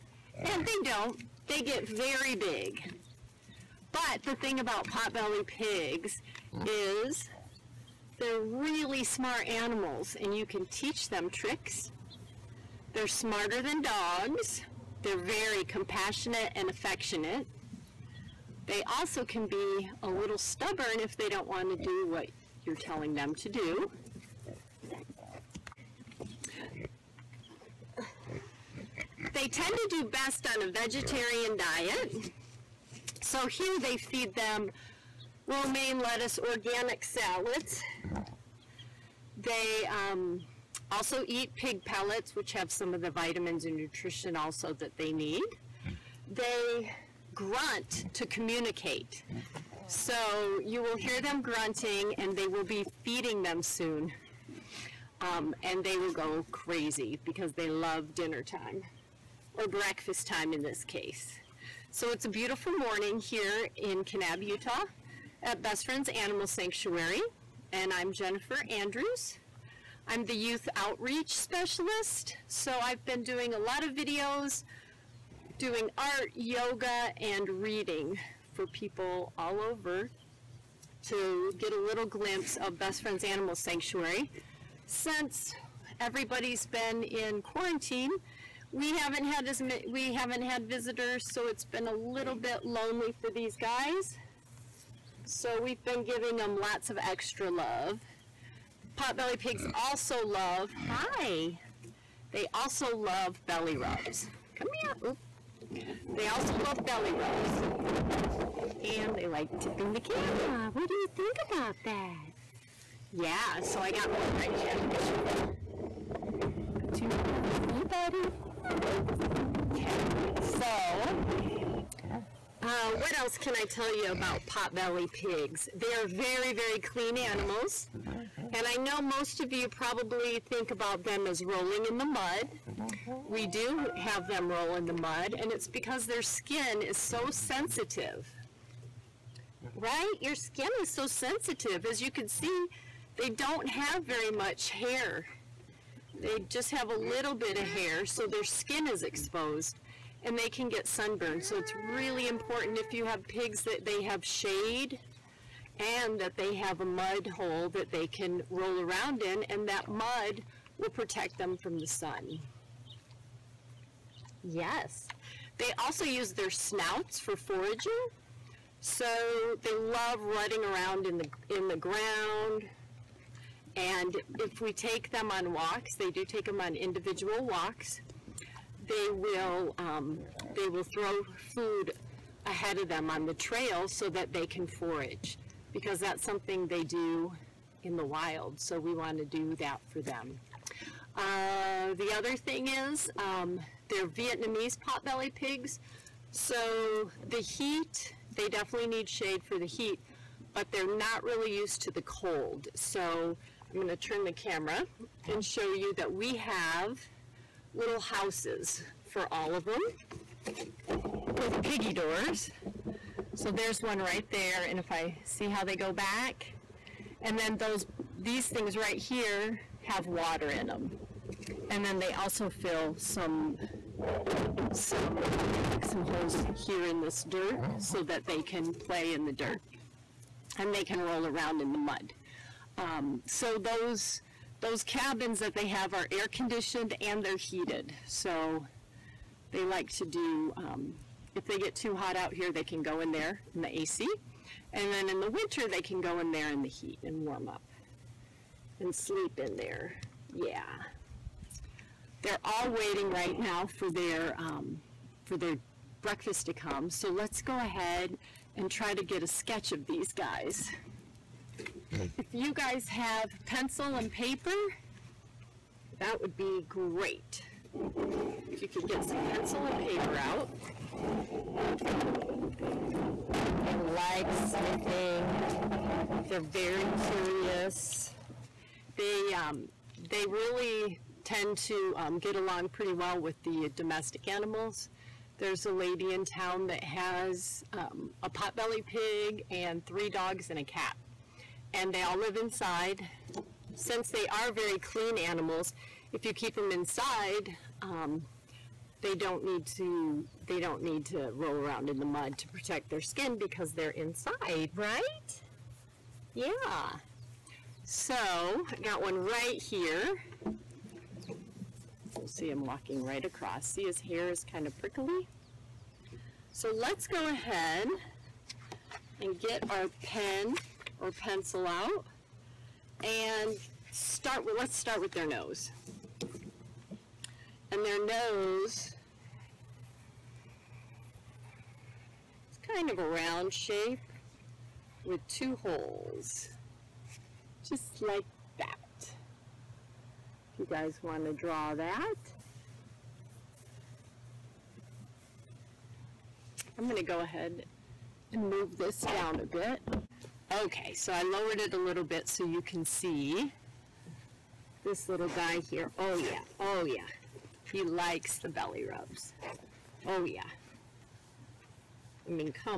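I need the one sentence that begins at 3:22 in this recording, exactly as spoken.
So I'm going to turn the camera and show you that we have little houses for all of them with piggy doors.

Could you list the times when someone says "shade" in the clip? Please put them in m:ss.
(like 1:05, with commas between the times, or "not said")
2:34, 3:19.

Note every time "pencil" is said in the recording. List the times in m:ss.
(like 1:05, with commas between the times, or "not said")
4:23, 4:29, 5:21.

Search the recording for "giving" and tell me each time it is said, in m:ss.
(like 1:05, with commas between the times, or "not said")
1:36.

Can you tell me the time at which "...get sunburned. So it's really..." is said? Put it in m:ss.
2:30.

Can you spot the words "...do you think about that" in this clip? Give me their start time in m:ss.
1:50.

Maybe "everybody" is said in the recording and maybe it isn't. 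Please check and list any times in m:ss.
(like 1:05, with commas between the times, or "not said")
1:25.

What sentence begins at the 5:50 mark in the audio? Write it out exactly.
Okay, so I lowered it a little bit so you can see this little guy here.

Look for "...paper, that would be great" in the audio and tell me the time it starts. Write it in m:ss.
4:24.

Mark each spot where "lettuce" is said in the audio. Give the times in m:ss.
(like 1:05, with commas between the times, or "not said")
0:35.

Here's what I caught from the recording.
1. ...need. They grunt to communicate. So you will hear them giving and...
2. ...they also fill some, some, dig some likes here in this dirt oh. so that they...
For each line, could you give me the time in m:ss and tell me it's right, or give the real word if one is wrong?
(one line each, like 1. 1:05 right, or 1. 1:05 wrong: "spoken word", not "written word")
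1. 0:45 wrong: "grunting", not "giving"
2. 3:41 wrong: "holes", not "likes".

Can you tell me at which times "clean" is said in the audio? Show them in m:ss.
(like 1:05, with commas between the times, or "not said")
2:06, 4:54.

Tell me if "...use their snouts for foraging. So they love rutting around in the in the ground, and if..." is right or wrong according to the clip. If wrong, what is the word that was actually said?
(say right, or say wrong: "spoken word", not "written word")
right.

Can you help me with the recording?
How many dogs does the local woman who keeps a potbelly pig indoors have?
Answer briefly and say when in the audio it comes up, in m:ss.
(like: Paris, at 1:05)
3, at 4:49.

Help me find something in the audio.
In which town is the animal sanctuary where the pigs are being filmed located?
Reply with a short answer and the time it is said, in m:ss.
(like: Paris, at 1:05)
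Kanab, Utah, at 1:04.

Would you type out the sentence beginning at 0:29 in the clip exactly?
They tend to do best on a vegetarian diet.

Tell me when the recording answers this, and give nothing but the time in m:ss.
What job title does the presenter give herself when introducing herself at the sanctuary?
1:10.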